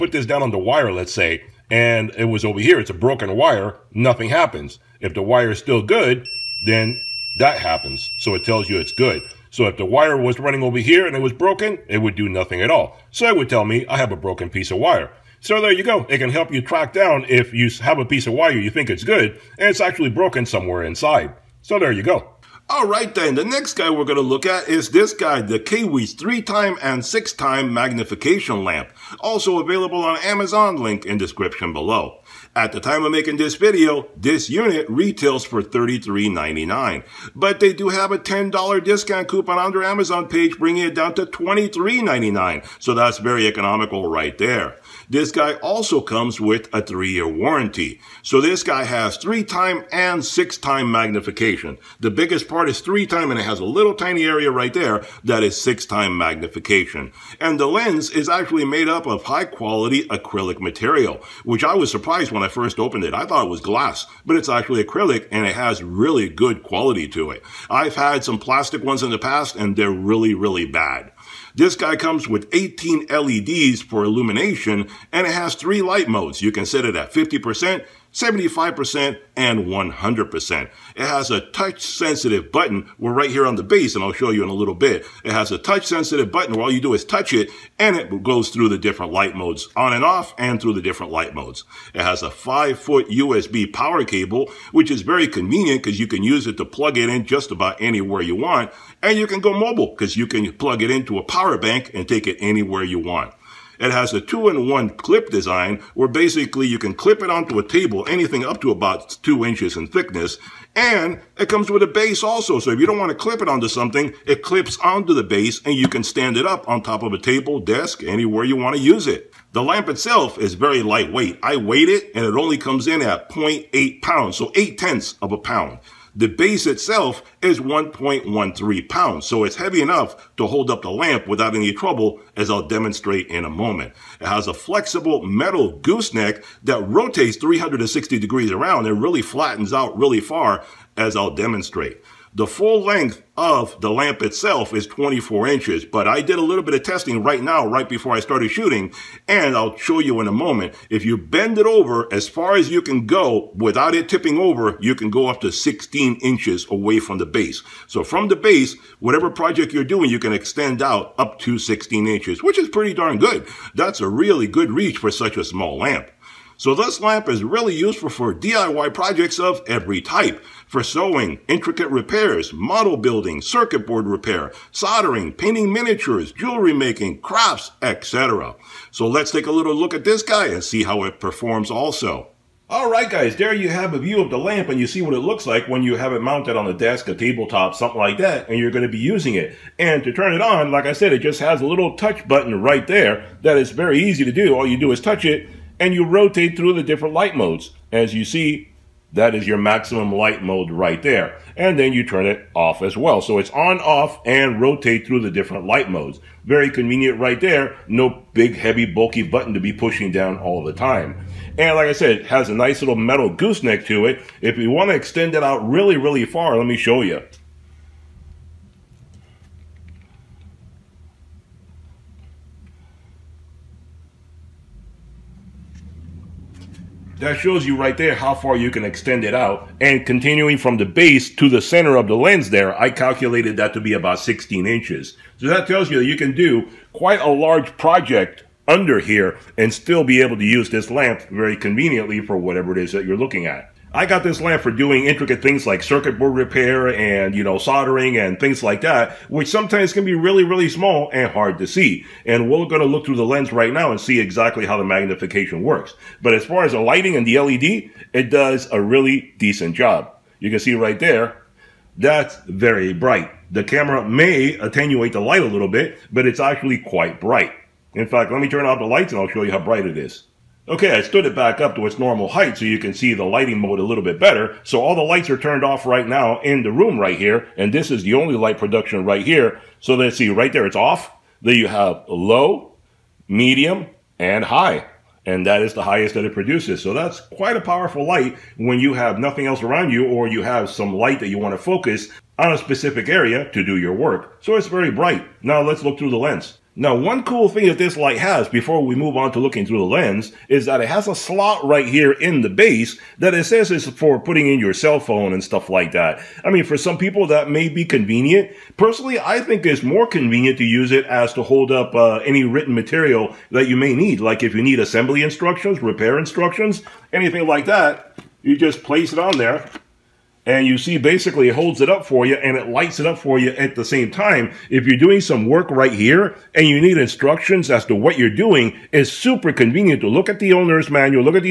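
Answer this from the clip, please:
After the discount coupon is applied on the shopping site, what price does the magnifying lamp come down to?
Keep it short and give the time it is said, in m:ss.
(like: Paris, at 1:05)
$23.99, at 0:41.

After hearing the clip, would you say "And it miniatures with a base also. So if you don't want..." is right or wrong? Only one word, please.
wrong.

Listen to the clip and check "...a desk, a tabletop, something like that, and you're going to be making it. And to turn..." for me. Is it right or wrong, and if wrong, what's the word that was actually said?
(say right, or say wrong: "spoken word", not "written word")
wrong: "using", not "making".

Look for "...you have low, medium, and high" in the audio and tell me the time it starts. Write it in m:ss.
4:41.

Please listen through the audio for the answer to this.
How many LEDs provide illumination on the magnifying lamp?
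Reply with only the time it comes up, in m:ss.
1:12.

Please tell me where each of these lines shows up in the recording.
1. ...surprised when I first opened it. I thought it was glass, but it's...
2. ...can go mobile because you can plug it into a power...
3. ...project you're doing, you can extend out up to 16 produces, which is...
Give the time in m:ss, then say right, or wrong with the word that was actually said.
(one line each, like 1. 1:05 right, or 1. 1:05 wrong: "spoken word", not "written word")
1. 1:01 right
2. 1:39 right
3. 2:39 wrong: "inches", not "produces".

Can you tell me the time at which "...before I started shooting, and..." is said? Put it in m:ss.
2:27.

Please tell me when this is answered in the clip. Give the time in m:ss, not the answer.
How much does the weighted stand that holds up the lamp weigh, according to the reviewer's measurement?
2:07.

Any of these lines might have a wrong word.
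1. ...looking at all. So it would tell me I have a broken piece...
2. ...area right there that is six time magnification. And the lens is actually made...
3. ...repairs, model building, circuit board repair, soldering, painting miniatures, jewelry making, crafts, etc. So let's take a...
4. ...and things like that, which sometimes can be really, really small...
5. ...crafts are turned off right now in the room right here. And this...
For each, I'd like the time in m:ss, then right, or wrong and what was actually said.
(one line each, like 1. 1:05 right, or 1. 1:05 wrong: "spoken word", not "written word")
1. 0:12 wrong: "nothing", not "looking"
2. 0:54 right
3. 2:51 right
4. 4:08 right
5. 4:35 wrong: "lights", not "crafts".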